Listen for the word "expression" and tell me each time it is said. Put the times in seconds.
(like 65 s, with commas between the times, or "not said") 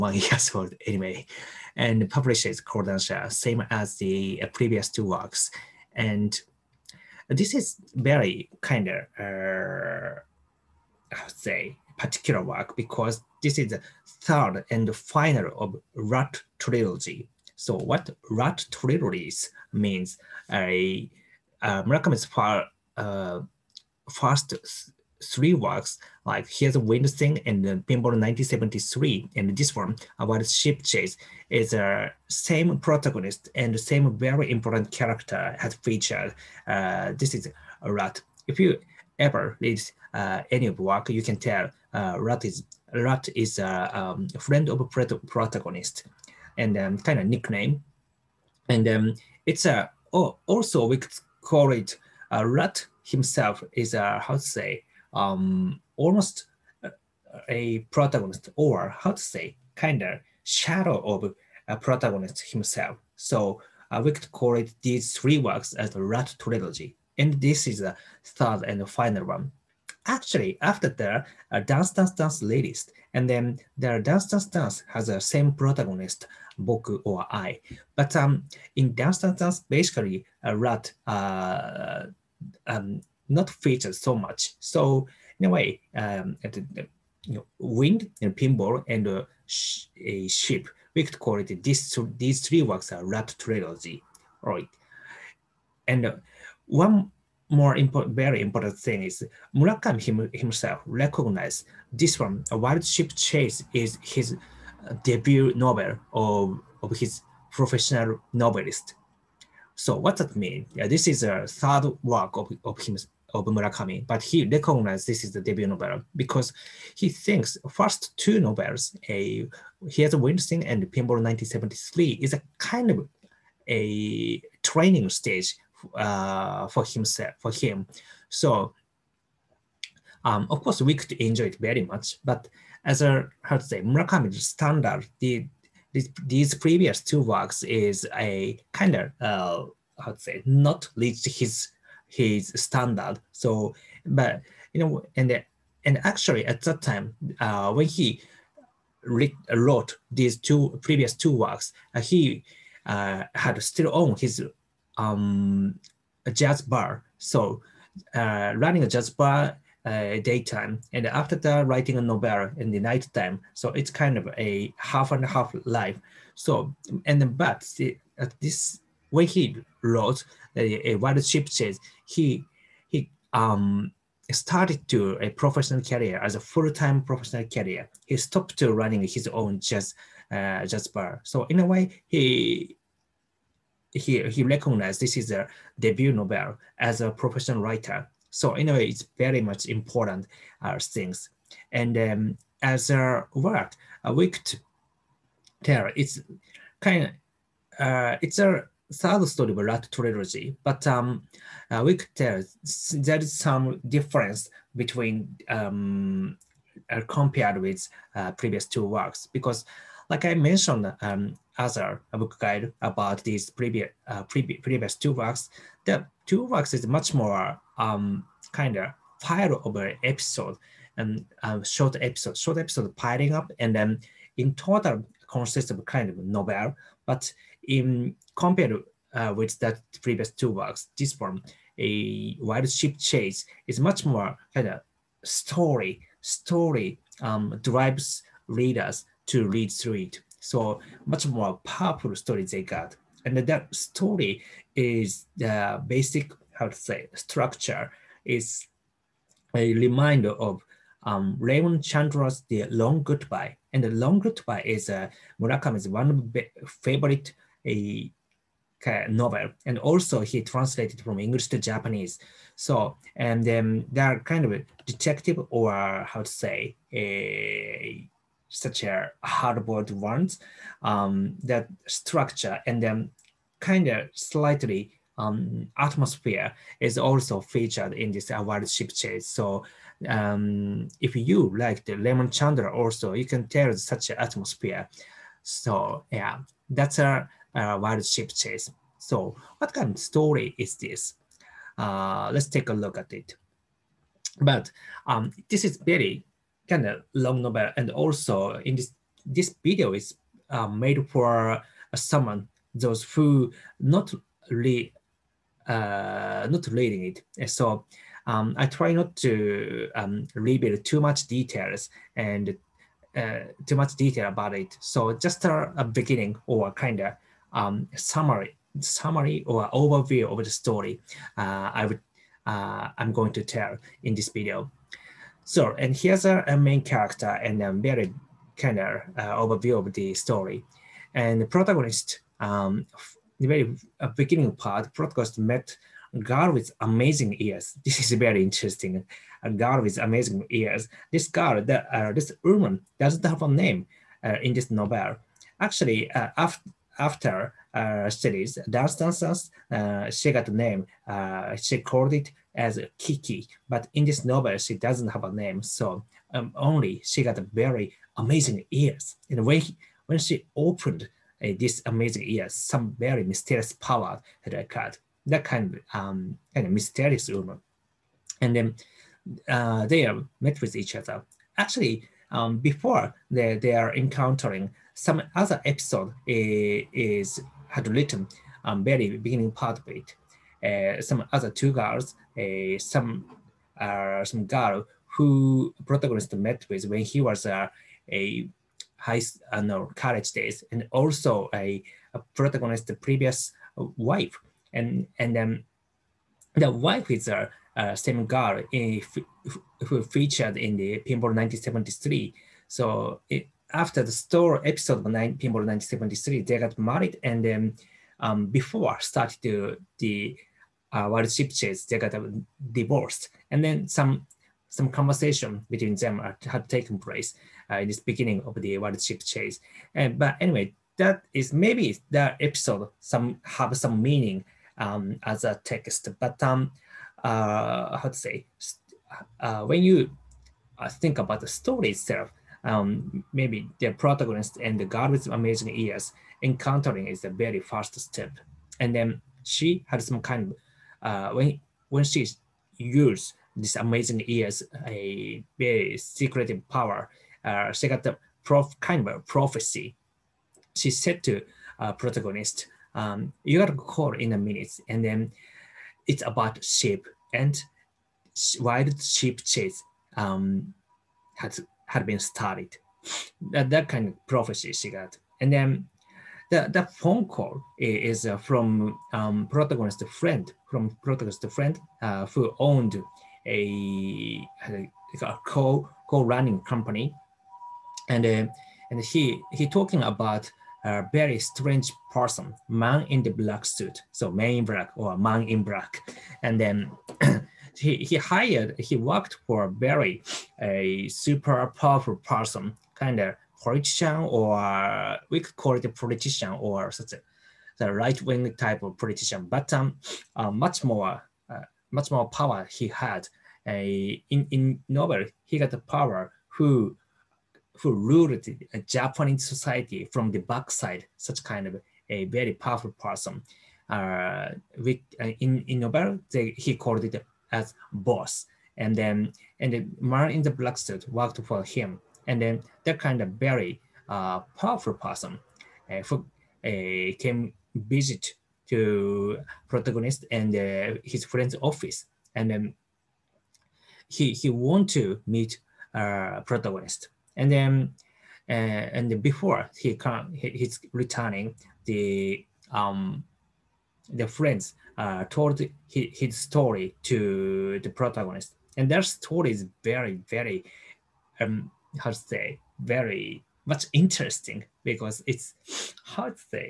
not said.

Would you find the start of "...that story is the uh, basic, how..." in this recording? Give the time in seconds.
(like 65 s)
243 s.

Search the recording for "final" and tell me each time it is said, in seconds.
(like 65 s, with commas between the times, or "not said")
14 s, 68 s.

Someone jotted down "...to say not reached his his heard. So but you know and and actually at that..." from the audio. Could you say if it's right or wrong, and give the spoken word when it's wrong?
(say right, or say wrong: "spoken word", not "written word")
wrong: "standard", not "heard".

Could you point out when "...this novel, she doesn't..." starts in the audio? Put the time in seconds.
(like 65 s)
354 s.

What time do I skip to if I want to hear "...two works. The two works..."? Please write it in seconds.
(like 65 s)
214 s.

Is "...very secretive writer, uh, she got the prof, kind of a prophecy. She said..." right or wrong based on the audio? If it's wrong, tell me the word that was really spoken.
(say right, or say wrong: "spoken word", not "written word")
wrong: "power", not "writer".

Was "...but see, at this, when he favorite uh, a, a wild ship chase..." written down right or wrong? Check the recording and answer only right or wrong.
wrong.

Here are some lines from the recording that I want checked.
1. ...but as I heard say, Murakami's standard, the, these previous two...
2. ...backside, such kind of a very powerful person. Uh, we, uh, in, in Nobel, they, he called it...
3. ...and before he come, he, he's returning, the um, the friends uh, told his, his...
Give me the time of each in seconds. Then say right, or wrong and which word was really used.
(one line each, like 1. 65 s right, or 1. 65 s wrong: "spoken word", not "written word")
1. 132 s right
2. 510 s right
3. 538 s right.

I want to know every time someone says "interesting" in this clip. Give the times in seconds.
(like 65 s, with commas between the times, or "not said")
338 s, 553 s.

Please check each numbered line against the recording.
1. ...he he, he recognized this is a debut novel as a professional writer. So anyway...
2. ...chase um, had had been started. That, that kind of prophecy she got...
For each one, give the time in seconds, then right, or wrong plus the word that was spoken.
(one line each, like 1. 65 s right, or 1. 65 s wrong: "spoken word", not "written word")
1. 182 s right
2. 459 s right.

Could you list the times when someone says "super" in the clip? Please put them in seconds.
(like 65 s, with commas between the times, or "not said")
491 s.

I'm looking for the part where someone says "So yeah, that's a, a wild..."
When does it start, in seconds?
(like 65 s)
285 s.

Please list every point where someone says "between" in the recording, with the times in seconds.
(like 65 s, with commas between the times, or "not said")
204 s, 415 s.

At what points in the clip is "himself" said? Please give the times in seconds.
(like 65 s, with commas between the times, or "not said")
53 s, 62 s, 100 s, 126 s.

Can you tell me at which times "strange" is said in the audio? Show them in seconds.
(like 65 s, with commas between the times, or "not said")
481 s.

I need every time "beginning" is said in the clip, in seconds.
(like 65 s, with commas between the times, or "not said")
315 s, 334 s, 379 s, 417 s.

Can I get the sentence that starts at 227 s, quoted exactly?
But in compared uh, with that previous two works, this one, a wild ship chase, is much more kind of story.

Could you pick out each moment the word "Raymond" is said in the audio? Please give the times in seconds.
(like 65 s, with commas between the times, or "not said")
251 s, 281 s.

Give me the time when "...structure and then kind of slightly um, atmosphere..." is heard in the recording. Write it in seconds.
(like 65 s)
271 s.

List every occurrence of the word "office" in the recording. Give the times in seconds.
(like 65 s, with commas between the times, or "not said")
531 s.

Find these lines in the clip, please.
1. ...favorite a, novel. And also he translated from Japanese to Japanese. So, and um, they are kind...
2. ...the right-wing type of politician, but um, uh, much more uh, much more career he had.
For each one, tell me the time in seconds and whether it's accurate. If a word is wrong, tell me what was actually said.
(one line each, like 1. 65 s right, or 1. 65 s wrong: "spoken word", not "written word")
1. 256 s wrong: "English", not "Japanese"
2. 497 s wrong: "power", not "career".